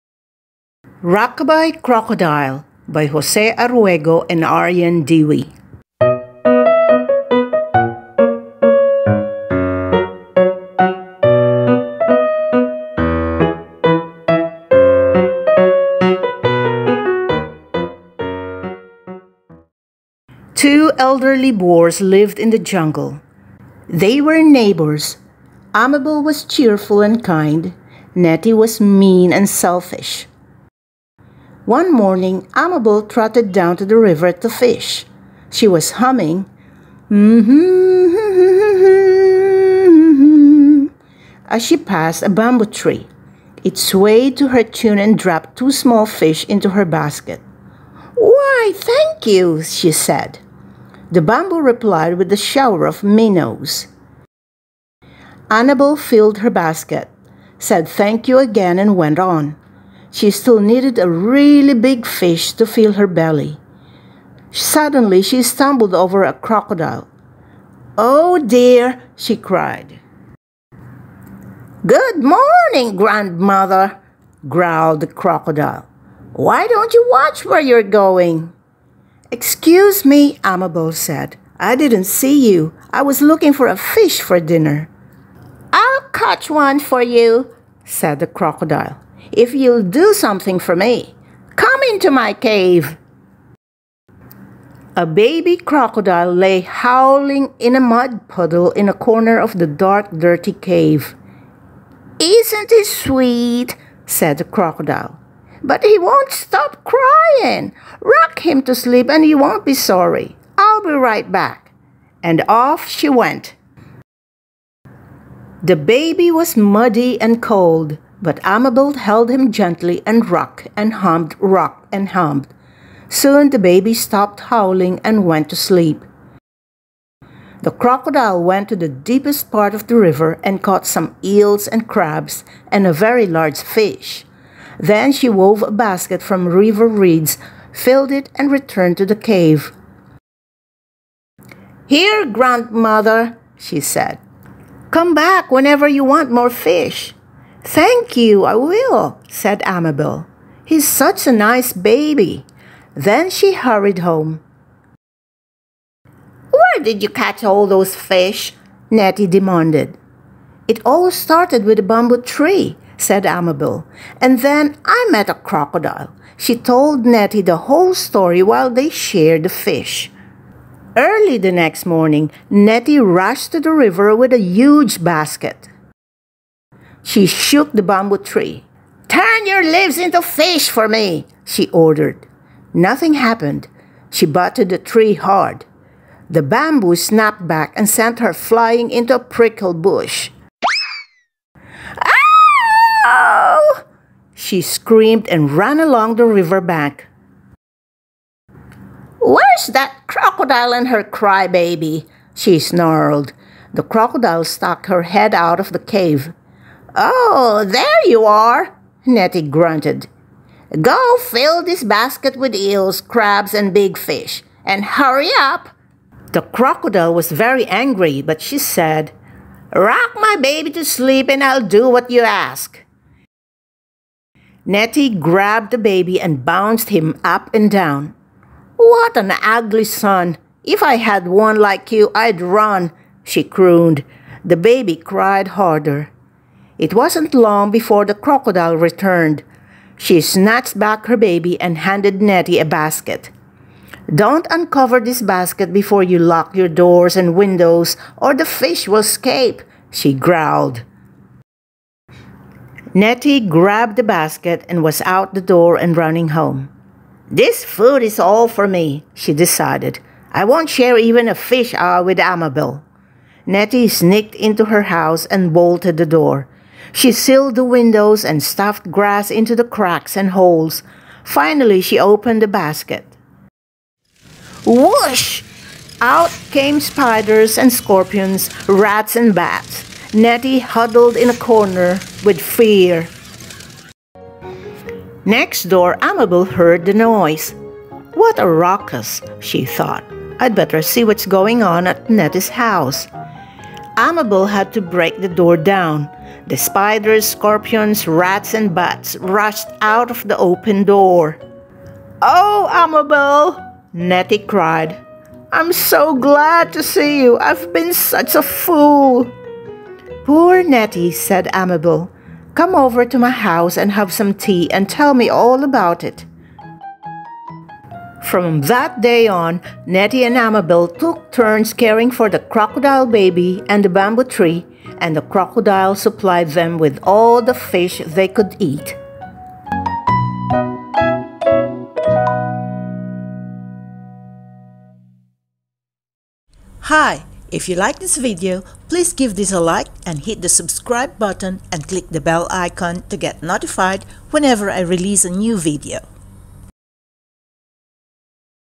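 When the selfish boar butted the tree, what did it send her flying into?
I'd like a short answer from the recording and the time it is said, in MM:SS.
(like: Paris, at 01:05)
A prickle bush, at 03:09.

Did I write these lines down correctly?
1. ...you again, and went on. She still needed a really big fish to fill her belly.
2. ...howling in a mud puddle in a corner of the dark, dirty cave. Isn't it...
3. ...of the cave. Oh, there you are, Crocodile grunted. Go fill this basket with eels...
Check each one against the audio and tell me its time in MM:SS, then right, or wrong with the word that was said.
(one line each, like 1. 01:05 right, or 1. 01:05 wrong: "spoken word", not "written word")
1. 00:58 right
2. 01:36 right
3. 03:25 wrong: "Nettie", not "Crocodile".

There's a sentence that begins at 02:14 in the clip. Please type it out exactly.
Then she wove a basket from river reeds, filled it, and returned to the cave.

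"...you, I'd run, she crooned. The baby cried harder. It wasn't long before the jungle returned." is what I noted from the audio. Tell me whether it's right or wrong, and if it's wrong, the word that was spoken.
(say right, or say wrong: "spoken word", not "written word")
wrong: "crocodile", not "jungle".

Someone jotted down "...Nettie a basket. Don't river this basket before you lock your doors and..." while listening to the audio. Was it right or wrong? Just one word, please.
wrong.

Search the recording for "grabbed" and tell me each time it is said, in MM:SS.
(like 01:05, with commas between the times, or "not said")
03:45, 04:13.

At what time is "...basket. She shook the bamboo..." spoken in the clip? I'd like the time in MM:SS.
02:55.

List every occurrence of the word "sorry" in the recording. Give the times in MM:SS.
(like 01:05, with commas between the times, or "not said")
01:49.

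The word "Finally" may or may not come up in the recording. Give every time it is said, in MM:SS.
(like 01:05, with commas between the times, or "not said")
04:31.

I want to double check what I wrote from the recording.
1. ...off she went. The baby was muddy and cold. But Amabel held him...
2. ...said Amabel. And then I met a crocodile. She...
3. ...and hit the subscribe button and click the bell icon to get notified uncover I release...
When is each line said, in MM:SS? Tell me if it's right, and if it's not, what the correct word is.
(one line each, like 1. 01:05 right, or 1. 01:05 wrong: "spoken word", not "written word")
1. 01:52 right
2. 02:42 right
3. 05:40 wrong: "whenever", not "uncover".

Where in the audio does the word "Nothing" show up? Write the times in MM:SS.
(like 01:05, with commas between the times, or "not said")
03:02.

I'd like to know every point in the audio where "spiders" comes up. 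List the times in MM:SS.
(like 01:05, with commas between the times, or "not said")
04:36, 04:56.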